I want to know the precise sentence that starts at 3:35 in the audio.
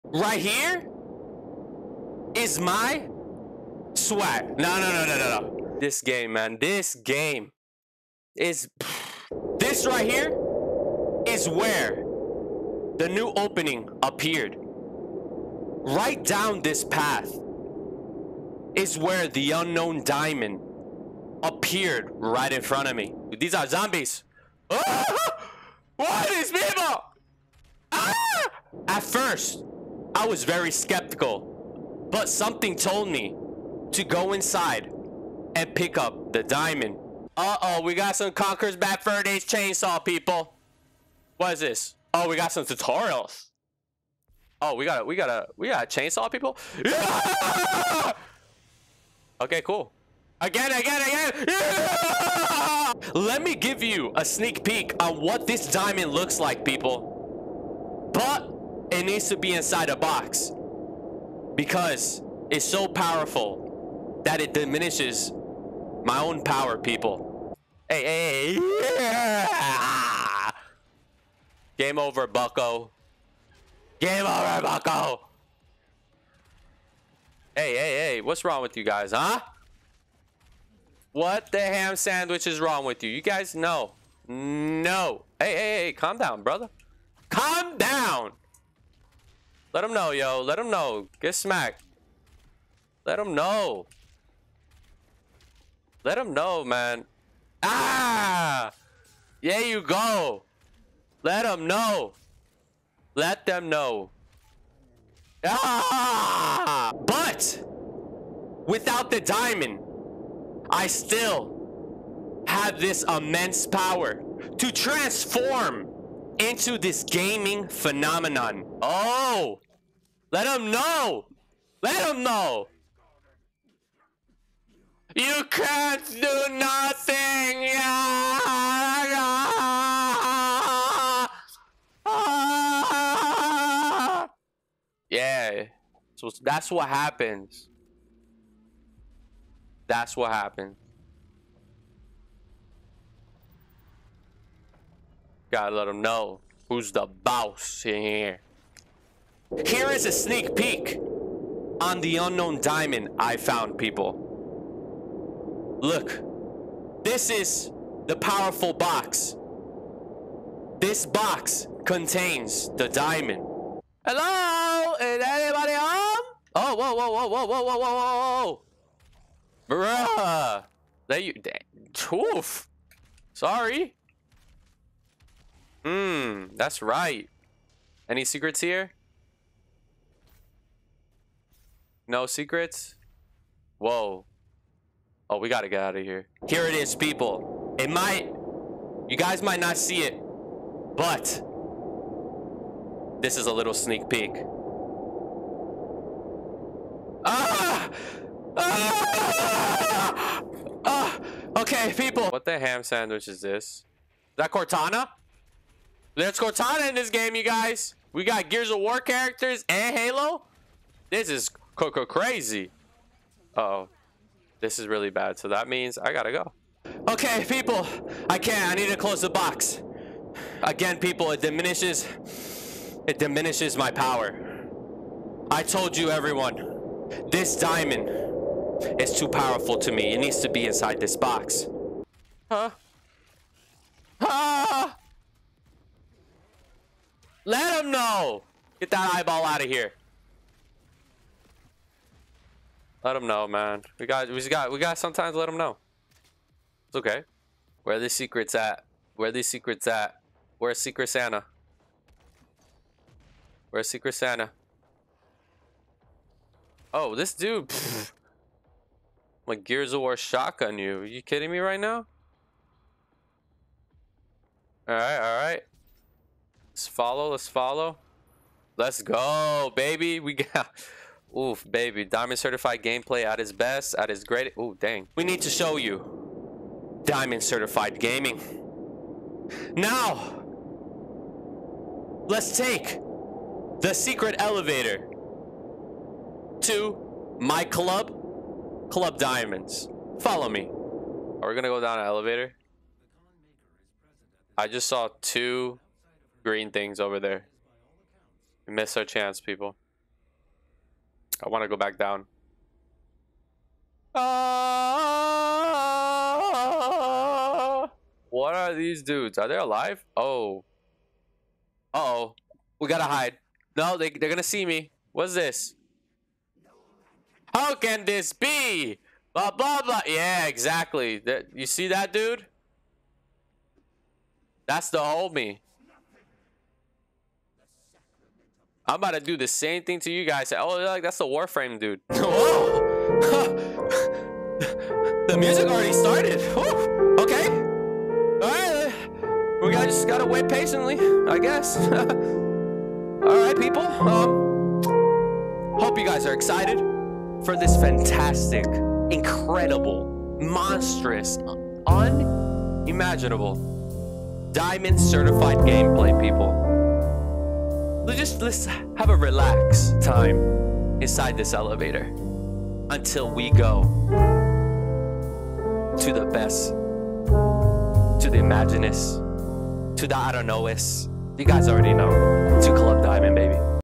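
So that means I gotta go.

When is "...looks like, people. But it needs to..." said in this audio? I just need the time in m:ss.
0:56.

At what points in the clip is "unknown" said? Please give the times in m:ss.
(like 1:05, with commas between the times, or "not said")
0:19, 2:32.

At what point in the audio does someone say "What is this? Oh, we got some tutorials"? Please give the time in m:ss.
0:41.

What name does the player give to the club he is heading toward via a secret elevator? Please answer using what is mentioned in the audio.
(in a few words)
Club Diamonds.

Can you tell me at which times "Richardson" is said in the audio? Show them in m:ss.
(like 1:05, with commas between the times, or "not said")
not said.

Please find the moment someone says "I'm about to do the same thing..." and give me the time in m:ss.
5:28.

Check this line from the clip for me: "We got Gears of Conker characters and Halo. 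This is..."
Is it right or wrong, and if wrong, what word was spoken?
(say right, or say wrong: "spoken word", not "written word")
wrong: "War", not "Conker".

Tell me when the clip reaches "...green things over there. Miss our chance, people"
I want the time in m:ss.
4:56.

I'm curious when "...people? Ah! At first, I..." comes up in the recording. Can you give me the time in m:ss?
0:26.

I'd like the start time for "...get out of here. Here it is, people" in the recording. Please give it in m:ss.
3:05.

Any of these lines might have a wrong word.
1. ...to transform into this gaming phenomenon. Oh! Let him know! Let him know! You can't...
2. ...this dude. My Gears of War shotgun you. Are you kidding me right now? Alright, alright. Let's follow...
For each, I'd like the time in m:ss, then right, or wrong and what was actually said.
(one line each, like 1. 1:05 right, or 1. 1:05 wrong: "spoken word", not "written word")
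1. 1:54 right
2. 4:17 right.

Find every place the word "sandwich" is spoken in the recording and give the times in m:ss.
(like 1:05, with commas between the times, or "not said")
1:21, 3:22.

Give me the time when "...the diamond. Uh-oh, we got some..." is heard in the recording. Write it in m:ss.
0:36.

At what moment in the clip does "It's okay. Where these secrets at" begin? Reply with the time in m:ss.
4:06.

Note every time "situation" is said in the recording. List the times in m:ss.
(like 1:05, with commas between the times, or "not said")
not said.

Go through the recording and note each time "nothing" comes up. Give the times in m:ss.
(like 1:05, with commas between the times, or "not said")
2:06.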